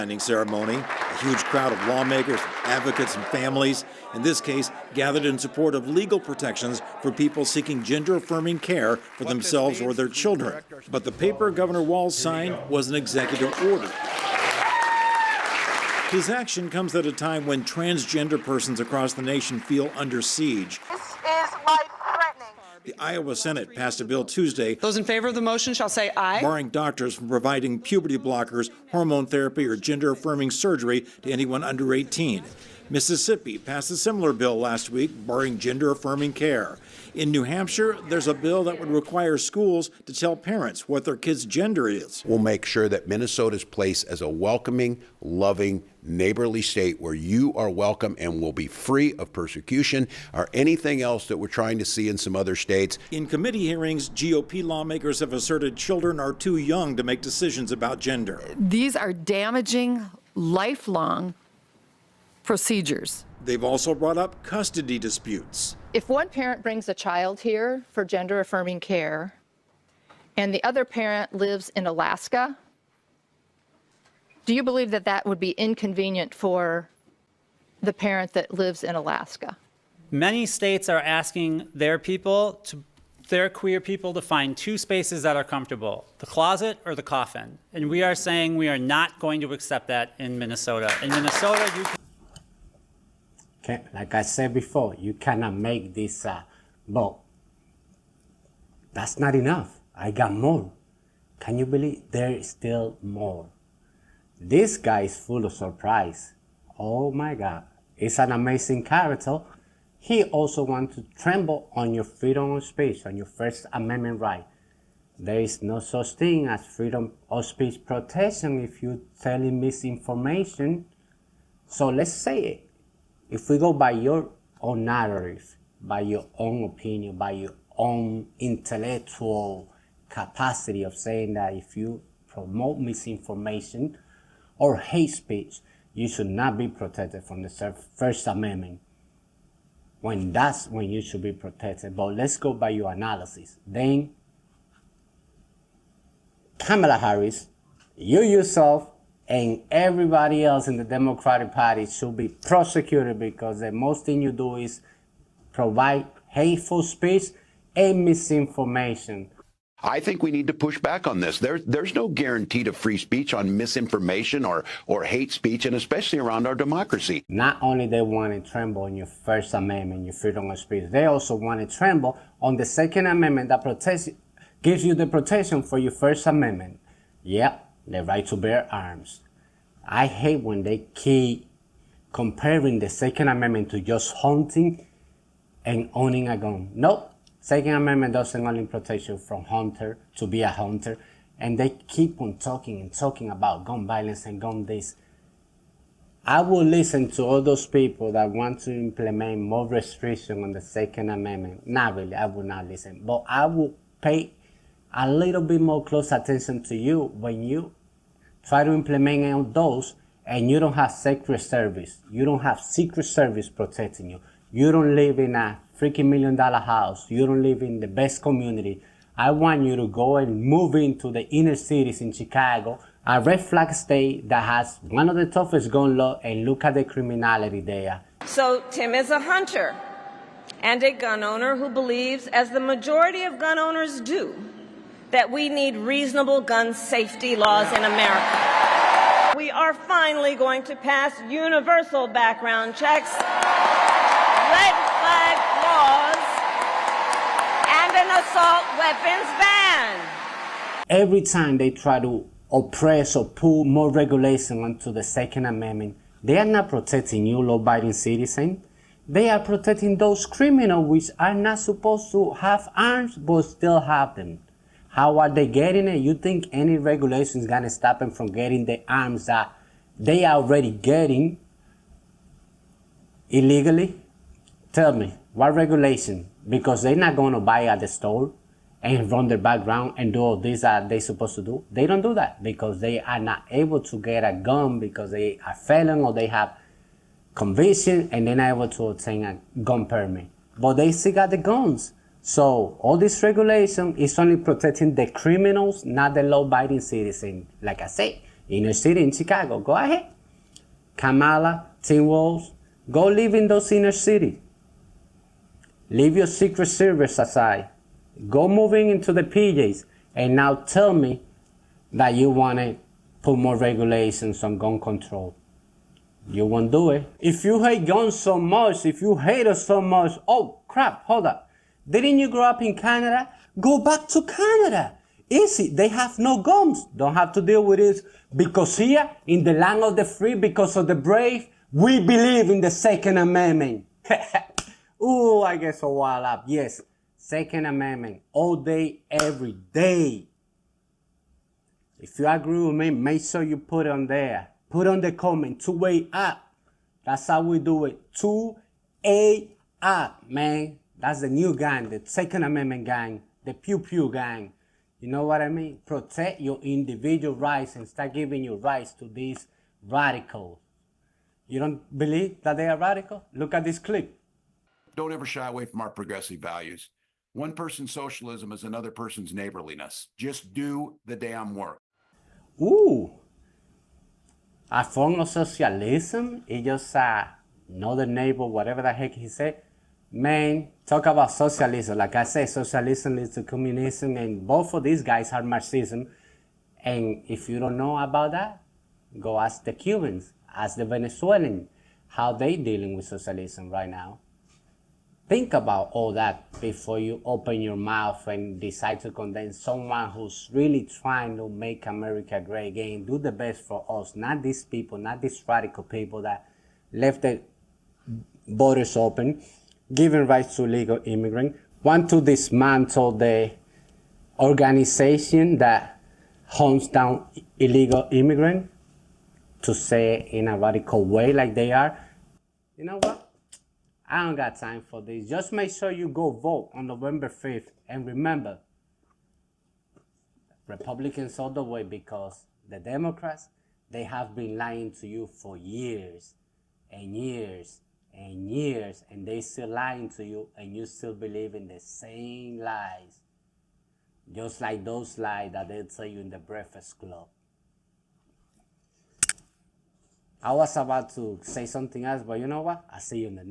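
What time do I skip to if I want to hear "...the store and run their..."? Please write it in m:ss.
4:37.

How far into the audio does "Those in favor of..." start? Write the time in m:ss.
0:24.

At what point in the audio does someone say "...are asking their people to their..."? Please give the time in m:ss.
1:20.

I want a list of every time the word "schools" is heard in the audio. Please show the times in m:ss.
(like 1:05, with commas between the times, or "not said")
0:39.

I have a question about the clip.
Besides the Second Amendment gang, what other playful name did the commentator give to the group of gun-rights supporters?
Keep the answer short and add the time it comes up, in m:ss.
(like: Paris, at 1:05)
Pew Pew gang, at 5:53.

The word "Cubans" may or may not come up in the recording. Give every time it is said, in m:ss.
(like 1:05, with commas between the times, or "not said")
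6:29.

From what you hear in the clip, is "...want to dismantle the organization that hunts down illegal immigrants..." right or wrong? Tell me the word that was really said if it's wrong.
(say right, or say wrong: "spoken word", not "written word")
right.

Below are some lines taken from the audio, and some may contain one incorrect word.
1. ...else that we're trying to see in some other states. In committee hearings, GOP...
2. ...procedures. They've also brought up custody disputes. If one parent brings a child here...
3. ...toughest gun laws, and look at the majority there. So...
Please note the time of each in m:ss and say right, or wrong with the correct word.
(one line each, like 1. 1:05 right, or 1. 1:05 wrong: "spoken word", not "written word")
1. 0:51 right
2. 1:02 right
3. 3:45 wrong: "criminality", not "majority".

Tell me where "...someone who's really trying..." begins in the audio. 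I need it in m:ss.
6:39.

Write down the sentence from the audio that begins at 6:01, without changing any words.
You don't believe that they are radical?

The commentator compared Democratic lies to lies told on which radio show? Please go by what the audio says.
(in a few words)
The Breakfast Club.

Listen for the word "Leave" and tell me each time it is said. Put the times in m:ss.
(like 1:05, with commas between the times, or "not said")
5:05.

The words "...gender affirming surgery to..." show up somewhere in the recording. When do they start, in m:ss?
0:29.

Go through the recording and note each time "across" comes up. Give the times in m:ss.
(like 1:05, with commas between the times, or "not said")
0:18.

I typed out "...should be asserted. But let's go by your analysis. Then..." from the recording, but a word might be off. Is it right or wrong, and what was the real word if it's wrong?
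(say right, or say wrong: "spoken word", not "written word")
wrong: "protected", not "asserted".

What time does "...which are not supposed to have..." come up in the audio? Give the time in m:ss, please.
4:20.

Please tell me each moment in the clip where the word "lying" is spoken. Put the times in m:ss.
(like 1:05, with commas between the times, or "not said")
7:14, 7:19.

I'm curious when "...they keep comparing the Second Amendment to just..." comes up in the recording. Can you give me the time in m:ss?
3:00.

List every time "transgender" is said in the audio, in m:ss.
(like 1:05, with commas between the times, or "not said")
0:17.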